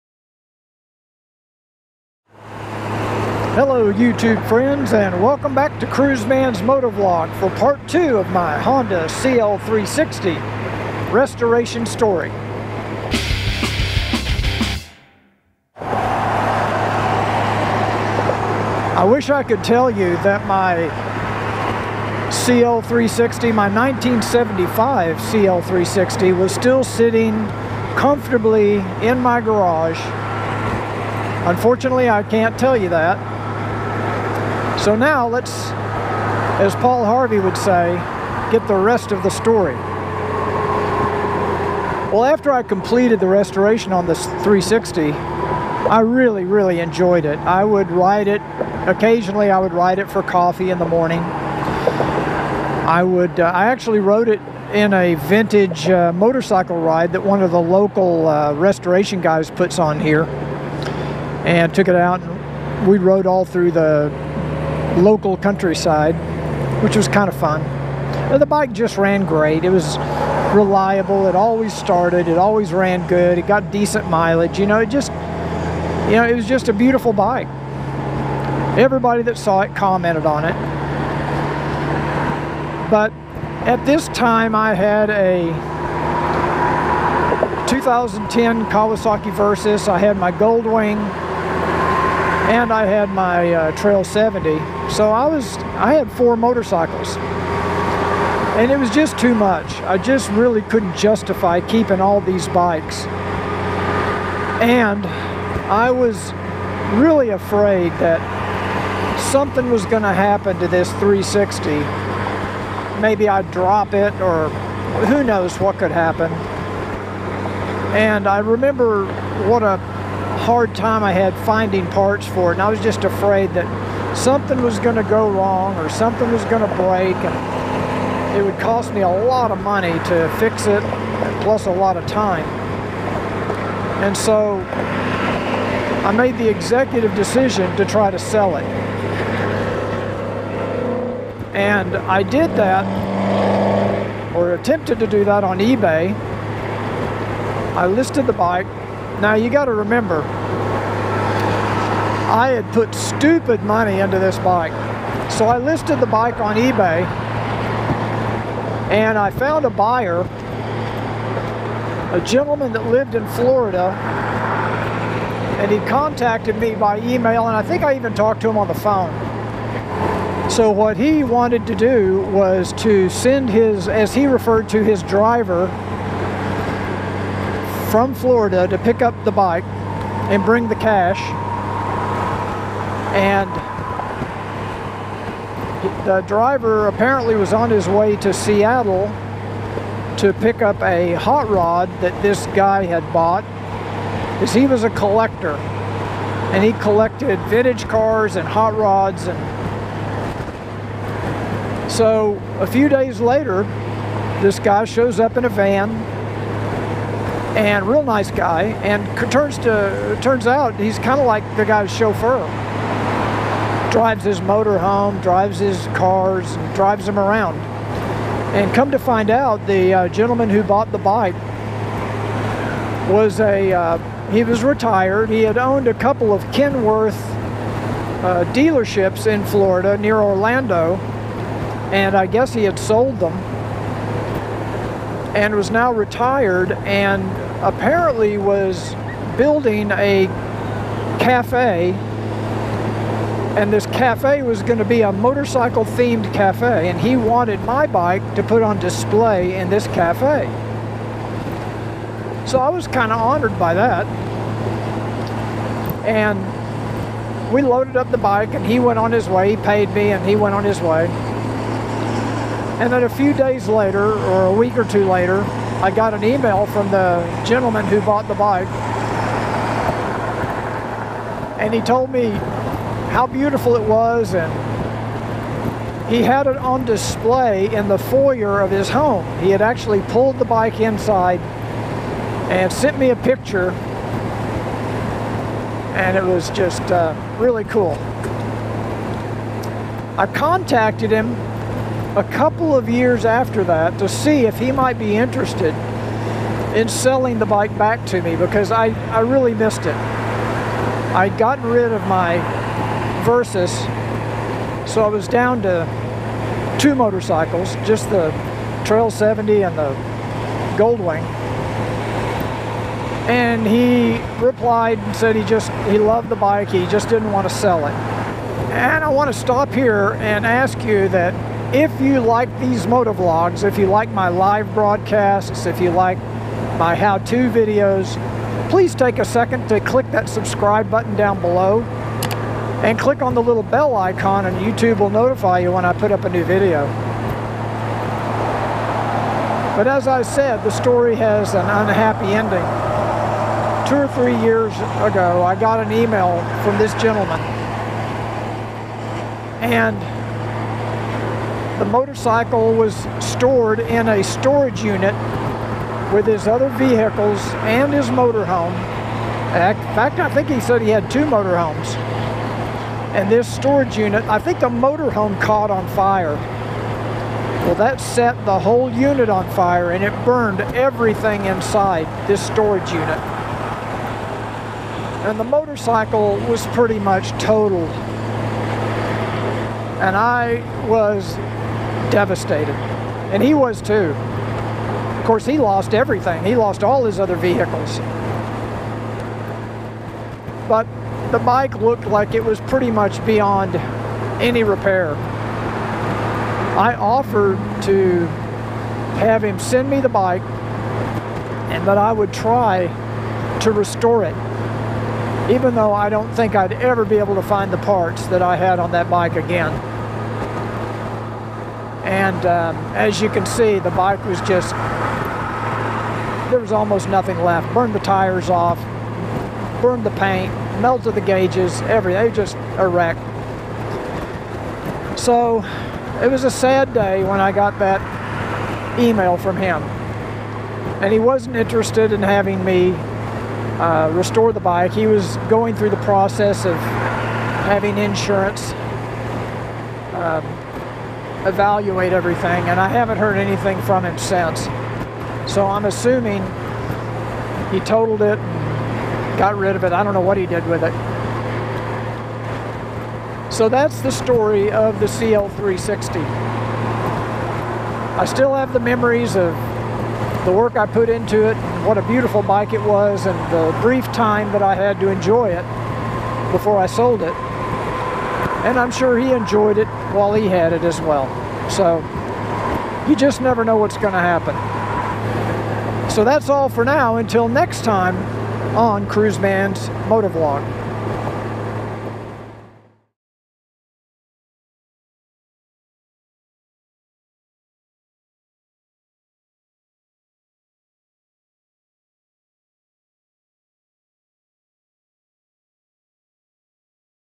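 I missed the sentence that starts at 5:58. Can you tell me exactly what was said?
In fact, I think he said he had two motorhomes and this storage unit, I think the motorhome caught on fire.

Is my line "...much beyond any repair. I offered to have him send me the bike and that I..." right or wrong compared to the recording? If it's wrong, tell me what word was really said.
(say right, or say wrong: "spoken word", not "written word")
right.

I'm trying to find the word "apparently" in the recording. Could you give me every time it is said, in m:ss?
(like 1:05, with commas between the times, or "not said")
3:06, 3:57.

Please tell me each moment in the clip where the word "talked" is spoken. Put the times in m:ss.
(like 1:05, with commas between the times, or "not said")
2:48.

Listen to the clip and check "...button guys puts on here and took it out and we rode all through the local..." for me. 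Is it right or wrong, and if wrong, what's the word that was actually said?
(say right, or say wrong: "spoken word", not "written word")
wrong: "restoration", not "button".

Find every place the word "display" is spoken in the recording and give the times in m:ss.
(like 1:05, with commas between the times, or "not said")
4:08, 4:36.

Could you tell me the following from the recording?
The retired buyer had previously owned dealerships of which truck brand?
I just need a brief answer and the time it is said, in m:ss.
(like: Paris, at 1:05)
Kenworth, at 3:46.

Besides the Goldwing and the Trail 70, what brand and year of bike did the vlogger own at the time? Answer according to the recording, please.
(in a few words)
2010 Kawasaki Versys.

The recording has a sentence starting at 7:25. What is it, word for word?
So I'm assuming he totaled it got rid of it.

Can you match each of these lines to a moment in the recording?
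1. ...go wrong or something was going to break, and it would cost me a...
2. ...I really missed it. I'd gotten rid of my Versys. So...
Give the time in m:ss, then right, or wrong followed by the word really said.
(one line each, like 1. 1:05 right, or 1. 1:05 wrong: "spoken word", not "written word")
1. 2:05 right
2. 4:59 right.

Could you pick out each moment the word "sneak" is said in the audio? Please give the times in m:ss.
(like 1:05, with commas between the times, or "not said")
not said.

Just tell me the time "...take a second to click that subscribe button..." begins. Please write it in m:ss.
5:28.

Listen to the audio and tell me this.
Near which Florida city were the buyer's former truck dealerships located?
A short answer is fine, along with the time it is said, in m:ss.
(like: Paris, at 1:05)
Orlando, at 3:50.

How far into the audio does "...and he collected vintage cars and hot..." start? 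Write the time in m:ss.
3:16.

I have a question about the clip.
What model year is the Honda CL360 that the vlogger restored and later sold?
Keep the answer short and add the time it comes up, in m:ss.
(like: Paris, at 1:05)
1975, at 0:23.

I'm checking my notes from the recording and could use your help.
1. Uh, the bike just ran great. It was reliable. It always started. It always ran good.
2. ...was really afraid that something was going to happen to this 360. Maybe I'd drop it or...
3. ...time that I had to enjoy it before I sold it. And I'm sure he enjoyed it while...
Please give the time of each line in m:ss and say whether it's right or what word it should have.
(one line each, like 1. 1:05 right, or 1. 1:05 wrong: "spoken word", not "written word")
1. 1:08 right
2. 1:45 right
3. 7:44 right.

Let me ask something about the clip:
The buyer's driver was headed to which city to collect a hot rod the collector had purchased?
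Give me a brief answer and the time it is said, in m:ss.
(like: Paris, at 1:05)
Seattle, at 3:08.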